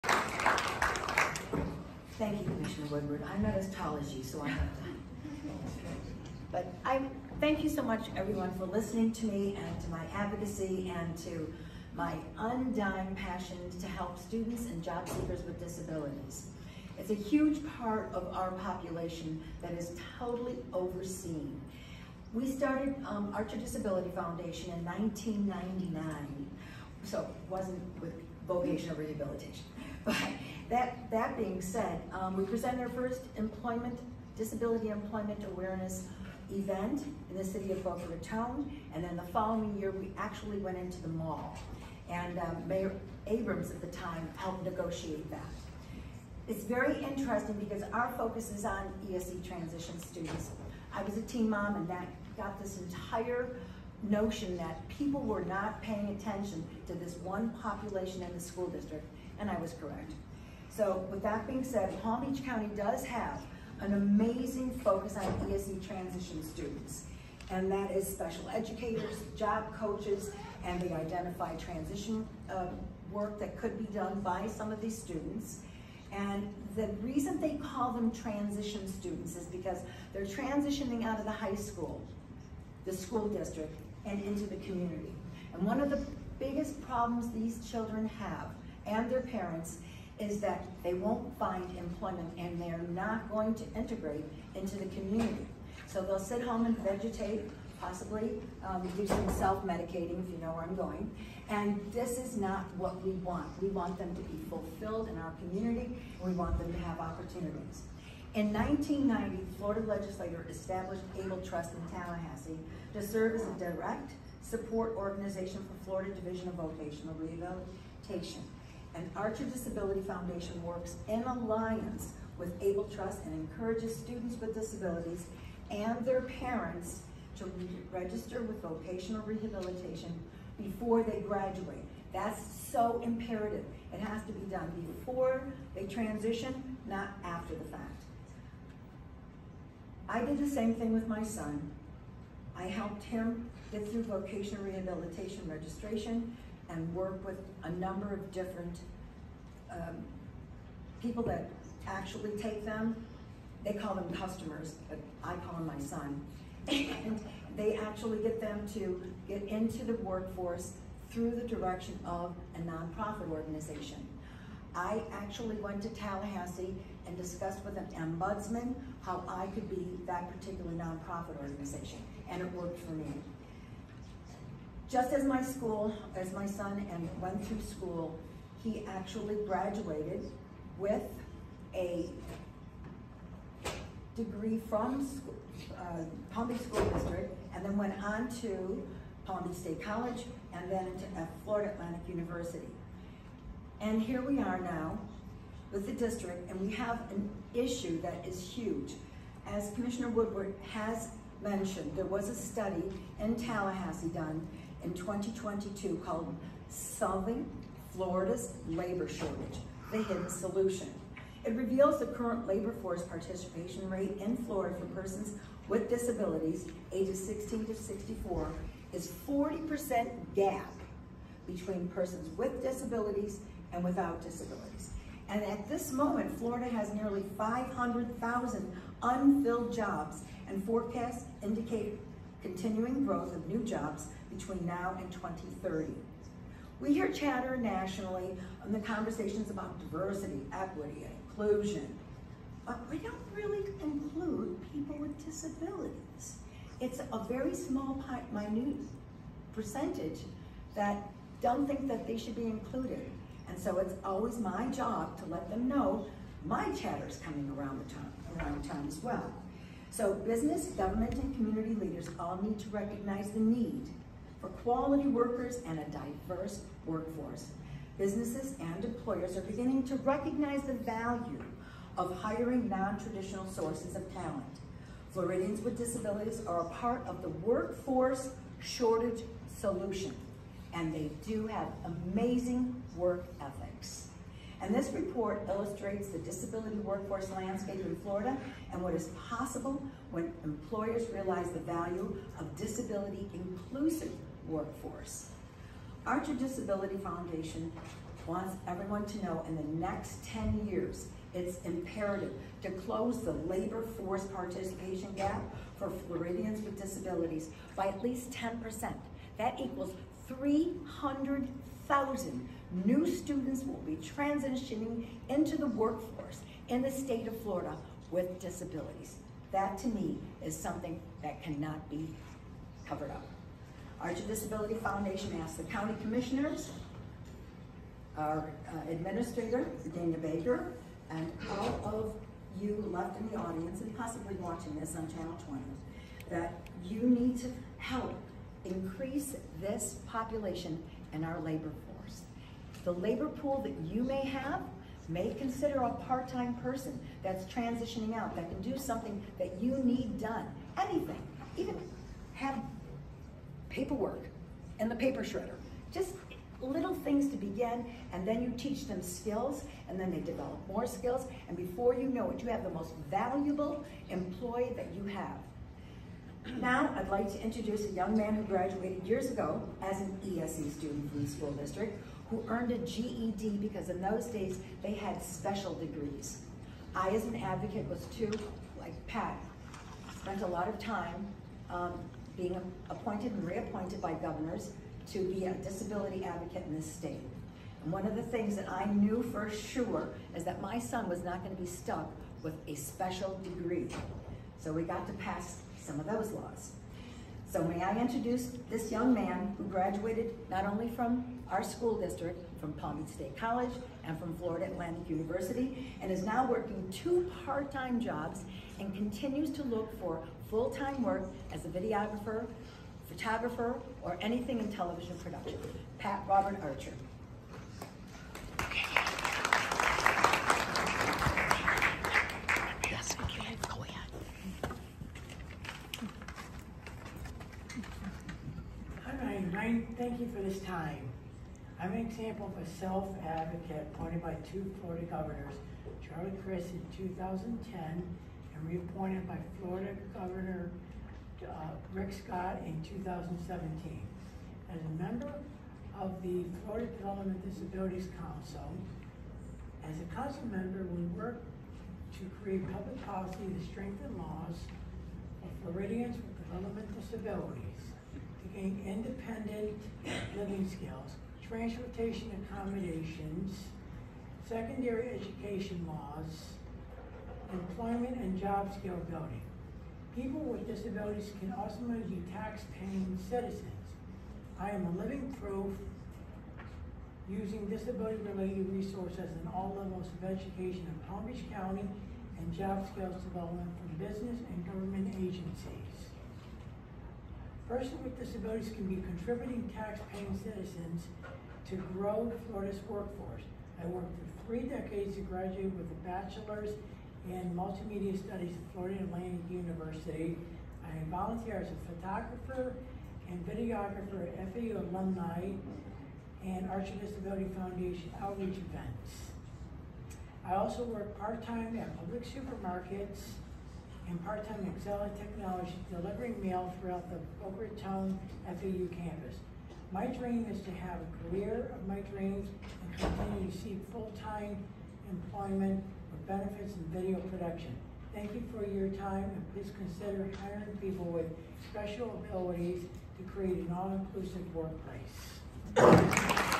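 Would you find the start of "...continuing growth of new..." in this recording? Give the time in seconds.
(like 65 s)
232 s.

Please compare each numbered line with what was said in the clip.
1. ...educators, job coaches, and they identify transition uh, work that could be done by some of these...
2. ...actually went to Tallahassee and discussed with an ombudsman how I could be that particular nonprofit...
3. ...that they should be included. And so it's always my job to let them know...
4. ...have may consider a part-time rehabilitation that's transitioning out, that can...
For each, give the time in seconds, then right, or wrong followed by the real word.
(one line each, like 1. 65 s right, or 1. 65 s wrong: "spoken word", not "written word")
1. 68 s right
2. 165 s right
3. 251 s right
4. 344 s wrong: "person", not "rehabilitation".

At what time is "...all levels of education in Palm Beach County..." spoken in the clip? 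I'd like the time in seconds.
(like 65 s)
479 s.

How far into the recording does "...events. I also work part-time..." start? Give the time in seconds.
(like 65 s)
508 s.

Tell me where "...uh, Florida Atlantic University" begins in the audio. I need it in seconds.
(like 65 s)
191 s.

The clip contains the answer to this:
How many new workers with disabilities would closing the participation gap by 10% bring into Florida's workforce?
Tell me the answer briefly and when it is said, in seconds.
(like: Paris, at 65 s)
300,000, at 310 s.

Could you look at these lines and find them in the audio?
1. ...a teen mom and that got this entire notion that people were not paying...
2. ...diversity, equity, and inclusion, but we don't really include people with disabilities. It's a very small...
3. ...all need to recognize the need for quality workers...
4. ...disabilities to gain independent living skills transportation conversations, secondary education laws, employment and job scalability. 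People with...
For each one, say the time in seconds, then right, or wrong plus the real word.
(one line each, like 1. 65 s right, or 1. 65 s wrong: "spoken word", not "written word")
1. 51 s right
2. 239 s right
3. 262 s right
4. 457 s wrong: "accommodations", not "conversations".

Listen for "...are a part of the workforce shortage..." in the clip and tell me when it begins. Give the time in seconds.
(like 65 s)
276 s.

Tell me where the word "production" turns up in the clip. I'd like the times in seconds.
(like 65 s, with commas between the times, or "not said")
415 s, 527 s.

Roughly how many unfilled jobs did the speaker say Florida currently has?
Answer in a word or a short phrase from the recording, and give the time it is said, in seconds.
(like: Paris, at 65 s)
500,000, at 227 s.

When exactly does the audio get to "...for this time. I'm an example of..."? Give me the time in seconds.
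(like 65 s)
430 s.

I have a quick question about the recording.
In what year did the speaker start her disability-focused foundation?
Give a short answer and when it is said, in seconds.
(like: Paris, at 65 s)
1999, at 24 s.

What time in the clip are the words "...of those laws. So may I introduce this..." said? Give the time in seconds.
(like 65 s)
395 s.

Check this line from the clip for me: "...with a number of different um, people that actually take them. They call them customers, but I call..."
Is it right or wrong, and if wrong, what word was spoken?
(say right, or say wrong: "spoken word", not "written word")
right.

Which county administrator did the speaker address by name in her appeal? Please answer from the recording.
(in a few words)
Dana Baker.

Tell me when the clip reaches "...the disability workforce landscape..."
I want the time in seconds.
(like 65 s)
286 s.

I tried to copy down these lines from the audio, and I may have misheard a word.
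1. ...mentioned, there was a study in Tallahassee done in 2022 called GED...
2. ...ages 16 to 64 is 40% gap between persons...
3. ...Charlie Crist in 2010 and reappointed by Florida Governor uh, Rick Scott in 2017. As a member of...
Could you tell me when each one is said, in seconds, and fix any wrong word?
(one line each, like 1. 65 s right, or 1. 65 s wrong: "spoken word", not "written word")
1. 201 s wrong: "Solving", not "GED"
2. 216 s right
3. 436 s right.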